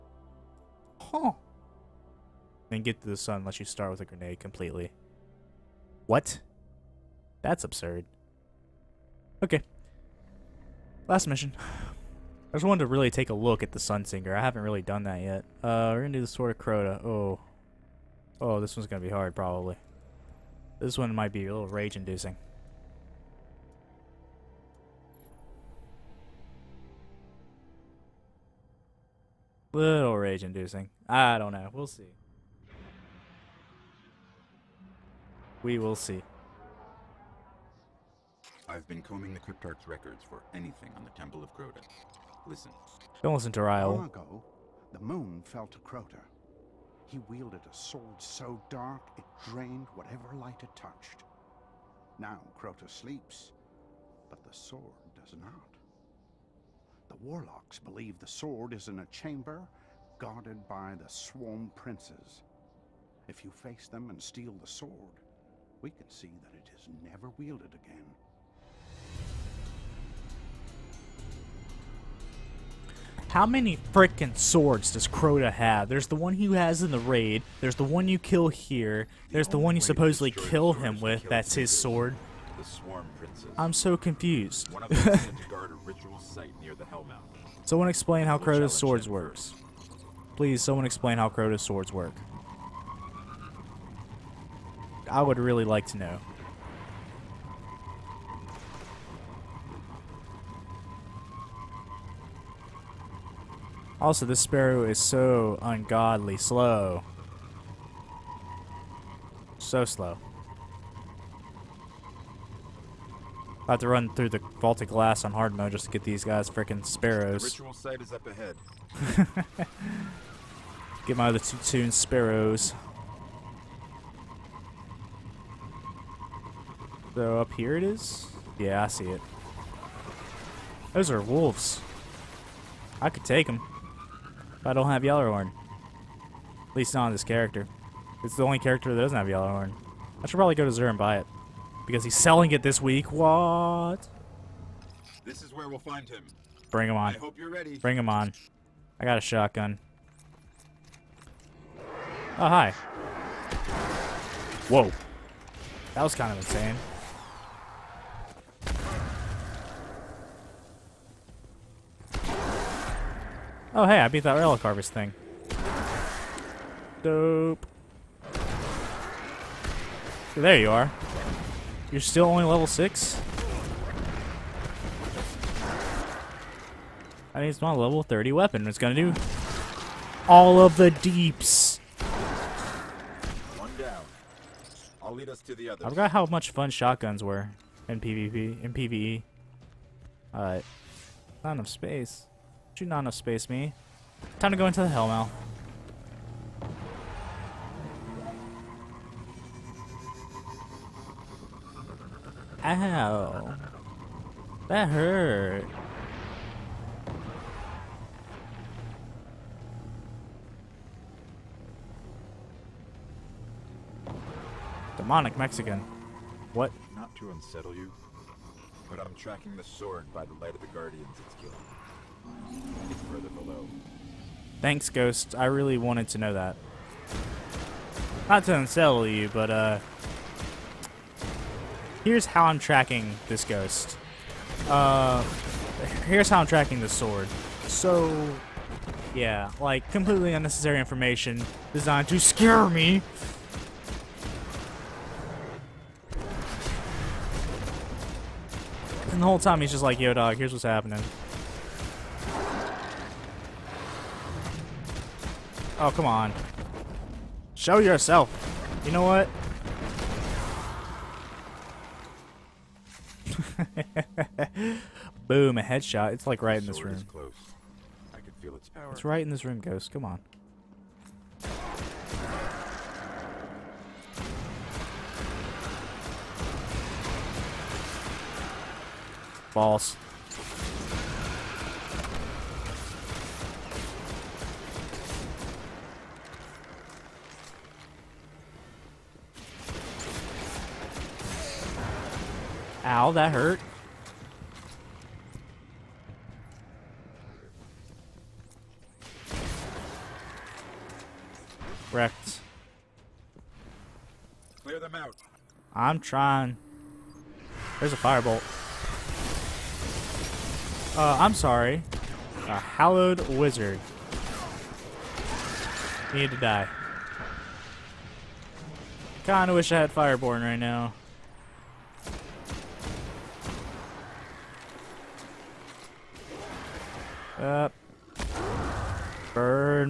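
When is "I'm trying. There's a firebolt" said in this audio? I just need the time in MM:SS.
05:05.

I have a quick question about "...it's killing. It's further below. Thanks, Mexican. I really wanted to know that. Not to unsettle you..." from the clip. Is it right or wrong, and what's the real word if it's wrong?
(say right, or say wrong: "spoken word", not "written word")
wrong: "Ghost", not "Mexican".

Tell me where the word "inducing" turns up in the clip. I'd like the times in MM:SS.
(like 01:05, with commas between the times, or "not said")
00:21, 00:30.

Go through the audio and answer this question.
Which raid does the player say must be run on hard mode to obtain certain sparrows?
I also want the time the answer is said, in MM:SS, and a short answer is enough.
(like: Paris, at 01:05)
Vault of Glass, at 01:54.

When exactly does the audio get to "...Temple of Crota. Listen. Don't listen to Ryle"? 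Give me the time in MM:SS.
00:41.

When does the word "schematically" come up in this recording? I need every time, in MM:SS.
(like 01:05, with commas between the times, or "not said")
not said.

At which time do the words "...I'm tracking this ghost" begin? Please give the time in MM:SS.
03:52.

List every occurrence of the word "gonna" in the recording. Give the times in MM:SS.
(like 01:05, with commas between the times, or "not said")
00:16, 02:58.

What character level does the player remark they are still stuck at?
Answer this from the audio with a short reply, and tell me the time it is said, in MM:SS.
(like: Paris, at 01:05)
6, at 02:52.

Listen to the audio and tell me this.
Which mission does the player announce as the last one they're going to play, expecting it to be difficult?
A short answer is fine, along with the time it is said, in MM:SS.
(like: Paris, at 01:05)
Sword of Crota, at 00:16.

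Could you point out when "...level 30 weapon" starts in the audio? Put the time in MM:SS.
02:57.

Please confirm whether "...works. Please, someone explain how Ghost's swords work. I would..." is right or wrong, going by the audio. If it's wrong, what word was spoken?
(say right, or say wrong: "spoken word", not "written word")
wrong: "Crota", not "Ghost".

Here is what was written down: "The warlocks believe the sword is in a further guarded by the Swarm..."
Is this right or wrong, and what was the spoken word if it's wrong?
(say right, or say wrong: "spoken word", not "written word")
wrong: "chamber", not "further".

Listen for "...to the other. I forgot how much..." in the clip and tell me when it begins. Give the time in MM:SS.
03:05.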